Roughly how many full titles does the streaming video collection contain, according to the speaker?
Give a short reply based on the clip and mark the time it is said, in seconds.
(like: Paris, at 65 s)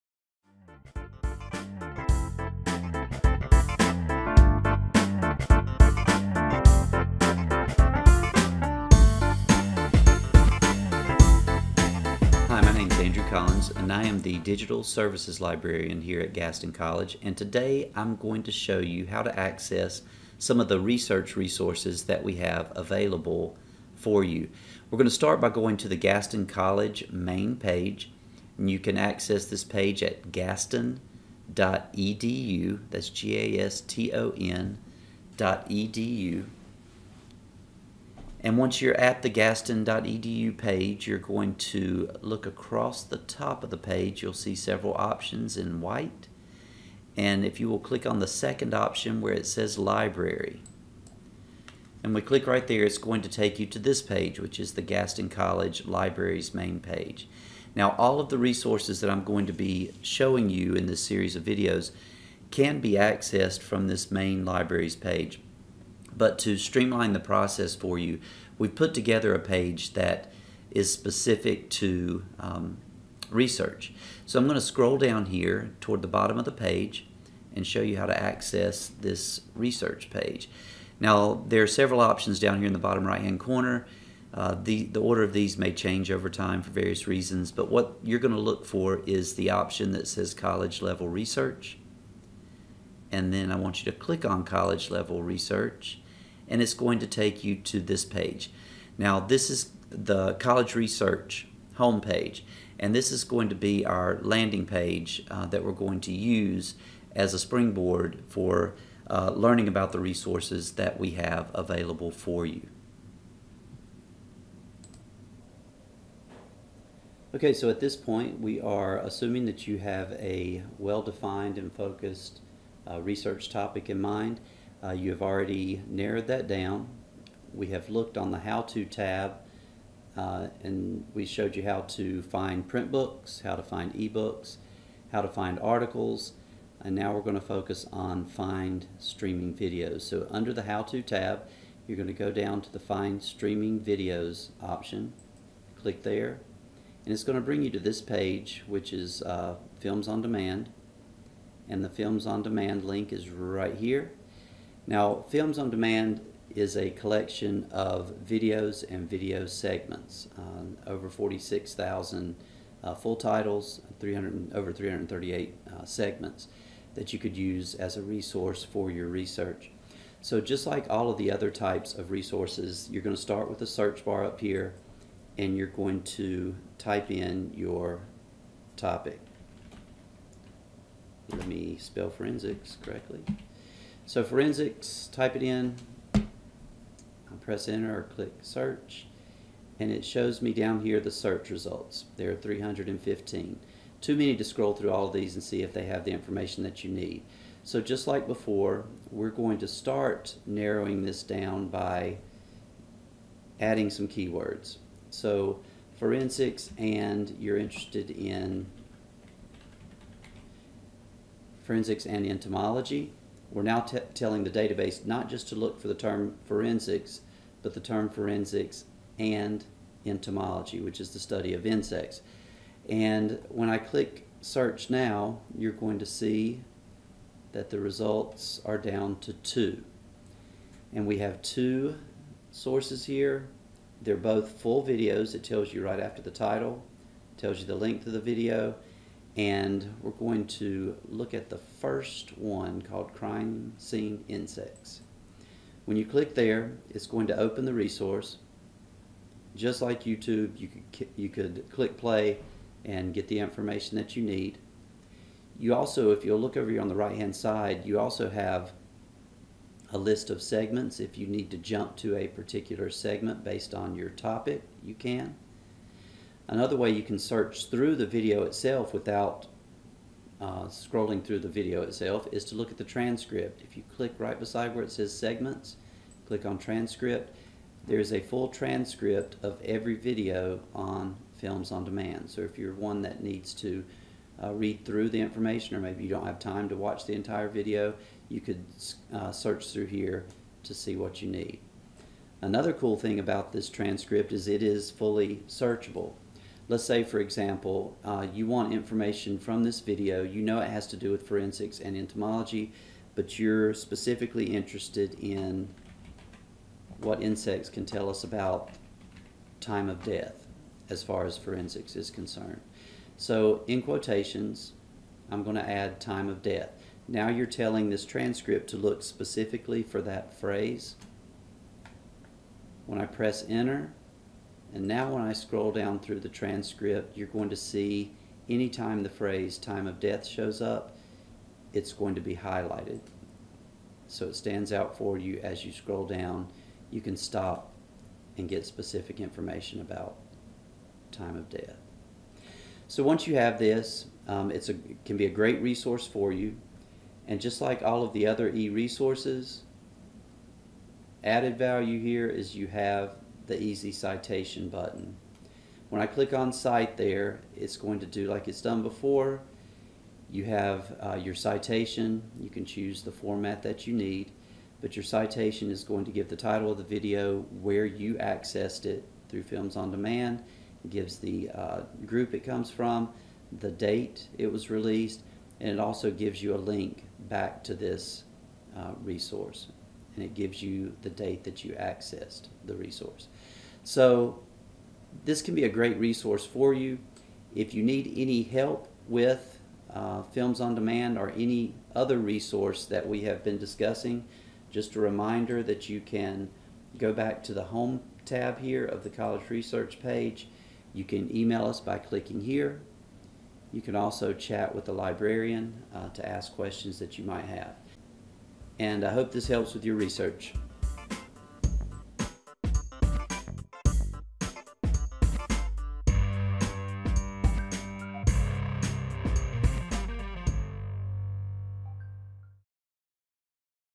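46,000, at 161 s.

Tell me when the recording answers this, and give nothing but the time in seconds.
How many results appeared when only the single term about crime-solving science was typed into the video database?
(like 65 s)
192 s.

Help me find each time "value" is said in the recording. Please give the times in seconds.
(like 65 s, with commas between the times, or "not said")
351 s.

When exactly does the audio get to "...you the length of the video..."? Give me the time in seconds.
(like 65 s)
237 s.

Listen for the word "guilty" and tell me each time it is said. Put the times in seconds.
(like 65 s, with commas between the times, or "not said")
not said.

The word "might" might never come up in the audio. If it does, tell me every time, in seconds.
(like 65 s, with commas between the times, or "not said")
407 s.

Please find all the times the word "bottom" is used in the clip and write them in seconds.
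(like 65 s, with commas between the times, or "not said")
76 s, 82 s.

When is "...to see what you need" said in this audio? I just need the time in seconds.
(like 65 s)
290 s.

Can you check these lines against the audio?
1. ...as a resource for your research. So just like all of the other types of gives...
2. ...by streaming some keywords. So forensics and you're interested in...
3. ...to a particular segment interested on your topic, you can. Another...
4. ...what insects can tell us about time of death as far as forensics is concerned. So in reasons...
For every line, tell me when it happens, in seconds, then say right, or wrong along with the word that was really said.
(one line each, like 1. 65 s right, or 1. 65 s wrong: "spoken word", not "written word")
1. 167 s wrong: "resources", not "gives"
2. 201 s wrong: "adding", not "streaming"
3. 261 s wrong: "based", not "interested"
4. 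306 s wrong: "quotations", not "reasons".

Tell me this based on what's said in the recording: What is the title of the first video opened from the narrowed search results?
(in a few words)
Crime Scene Insects.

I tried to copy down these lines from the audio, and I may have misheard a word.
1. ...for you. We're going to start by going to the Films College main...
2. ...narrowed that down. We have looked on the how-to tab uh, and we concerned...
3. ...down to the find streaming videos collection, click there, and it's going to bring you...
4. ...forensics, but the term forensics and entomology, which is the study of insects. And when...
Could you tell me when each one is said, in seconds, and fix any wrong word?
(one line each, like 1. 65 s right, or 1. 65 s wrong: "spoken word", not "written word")
1. 23 s wrong: "Gaston", not "Films"
2. 125 s wrong: "showed", not "concerned"
3. 142 s wrong: "option", not "collection"
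4. 216 s right.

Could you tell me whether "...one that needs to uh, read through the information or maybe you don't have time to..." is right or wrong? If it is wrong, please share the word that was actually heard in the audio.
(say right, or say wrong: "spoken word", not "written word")
right.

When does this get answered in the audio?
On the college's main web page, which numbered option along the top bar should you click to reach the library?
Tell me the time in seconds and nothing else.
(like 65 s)
48 s.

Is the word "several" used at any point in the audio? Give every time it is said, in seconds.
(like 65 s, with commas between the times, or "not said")
44 s, 81 s.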